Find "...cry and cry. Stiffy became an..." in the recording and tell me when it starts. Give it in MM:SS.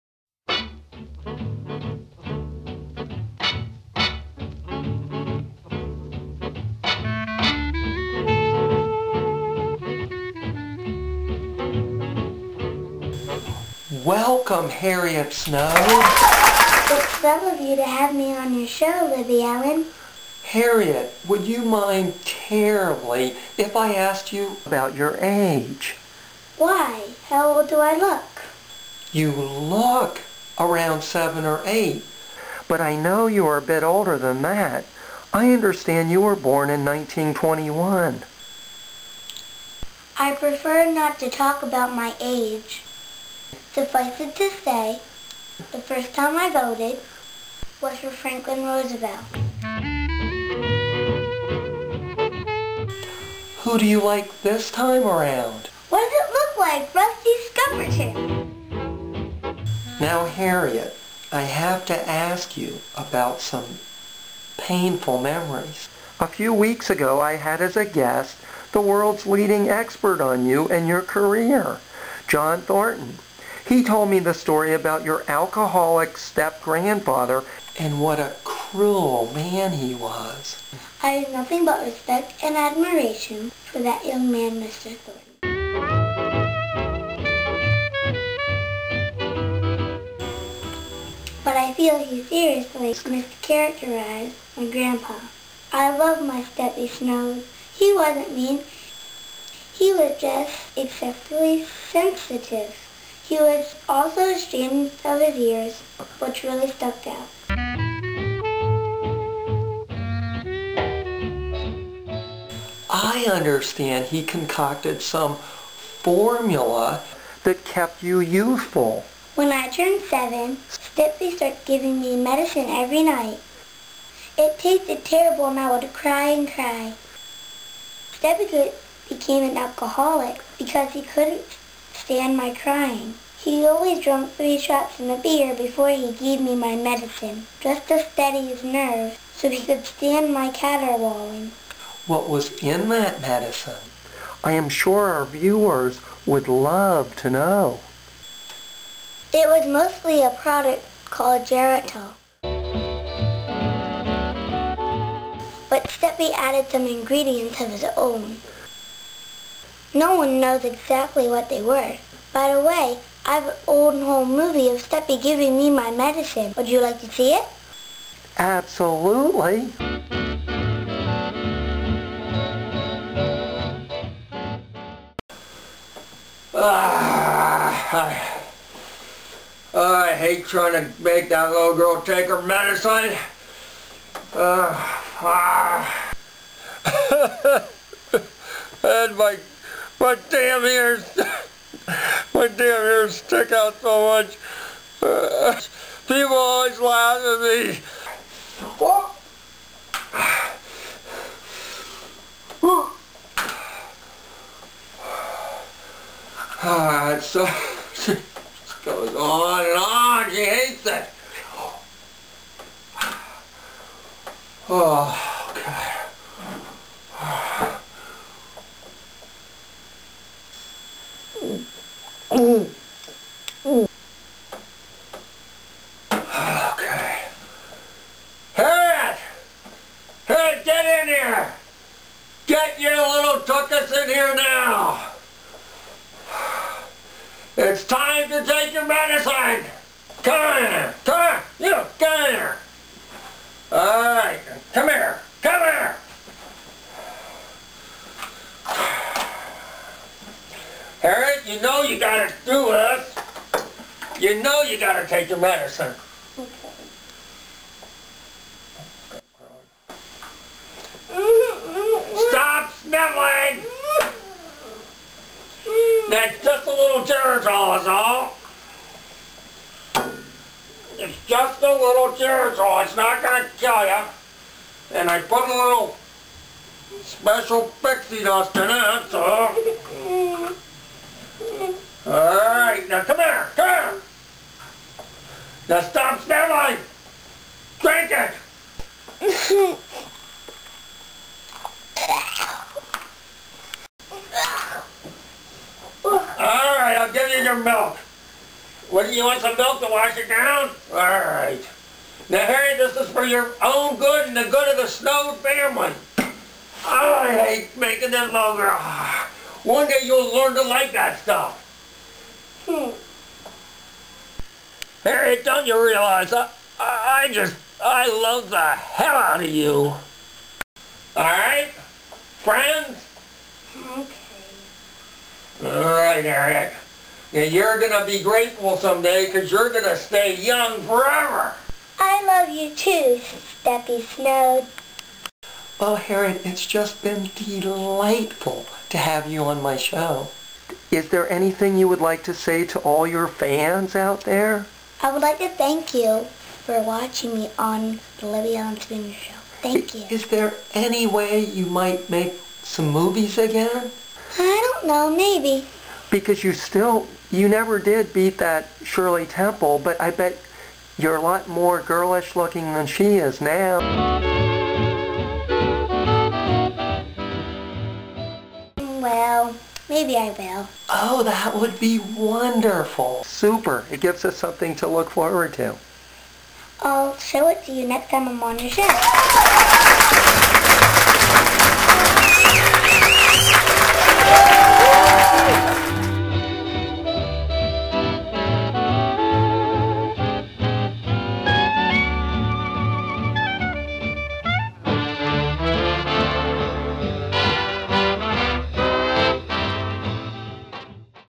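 02:05.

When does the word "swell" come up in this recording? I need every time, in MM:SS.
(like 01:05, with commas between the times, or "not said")
00:17.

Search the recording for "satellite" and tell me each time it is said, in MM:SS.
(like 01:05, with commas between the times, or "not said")
not said.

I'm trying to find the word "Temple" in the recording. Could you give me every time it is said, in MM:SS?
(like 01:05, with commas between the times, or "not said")
05:59.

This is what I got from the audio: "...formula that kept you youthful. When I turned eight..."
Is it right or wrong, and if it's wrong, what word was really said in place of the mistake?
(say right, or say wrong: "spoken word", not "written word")
wrong: "seven", not "eight".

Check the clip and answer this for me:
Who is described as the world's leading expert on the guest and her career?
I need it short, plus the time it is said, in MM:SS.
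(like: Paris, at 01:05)
John Thornton, at 01:12.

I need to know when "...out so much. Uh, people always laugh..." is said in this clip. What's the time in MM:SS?
03:13.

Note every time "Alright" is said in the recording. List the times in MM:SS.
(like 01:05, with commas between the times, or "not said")
03:26, 04:42, 05:21, 05:25.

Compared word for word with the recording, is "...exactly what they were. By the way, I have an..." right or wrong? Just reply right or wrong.
right.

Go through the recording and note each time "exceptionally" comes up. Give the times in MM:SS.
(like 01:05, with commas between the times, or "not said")
01:40.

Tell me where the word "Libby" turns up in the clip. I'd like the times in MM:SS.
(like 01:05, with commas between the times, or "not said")
00:19, 05:48.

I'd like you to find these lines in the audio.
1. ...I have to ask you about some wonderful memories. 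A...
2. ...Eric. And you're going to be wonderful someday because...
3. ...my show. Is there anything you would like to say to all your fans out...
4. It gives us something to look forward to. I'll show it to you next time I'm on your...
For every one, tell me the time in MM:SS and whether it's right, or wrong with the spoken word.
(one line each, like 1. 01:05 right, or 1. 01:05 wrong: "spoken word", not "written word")
1. 01:01 wrong: "painful", not "wonderful"
2. 05:26 wrong: "grateful", not "wonderful"
3. 05:39 right
4. 06:13 right.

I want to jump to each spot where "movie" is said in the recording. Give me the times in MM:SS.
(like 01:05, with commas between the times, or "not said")
02:44, 05:52.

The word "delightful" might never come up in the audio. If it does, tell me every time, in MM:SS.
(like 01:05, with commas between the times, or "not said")
05:37.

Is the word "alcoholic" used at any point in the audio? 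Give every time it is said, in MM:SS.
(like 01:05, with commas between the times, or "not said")
01:15, 02:09.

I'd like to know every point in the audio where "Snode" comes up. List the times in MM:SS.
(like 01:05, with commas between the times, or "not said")
00:15, 01:36, 05:04, 05:34.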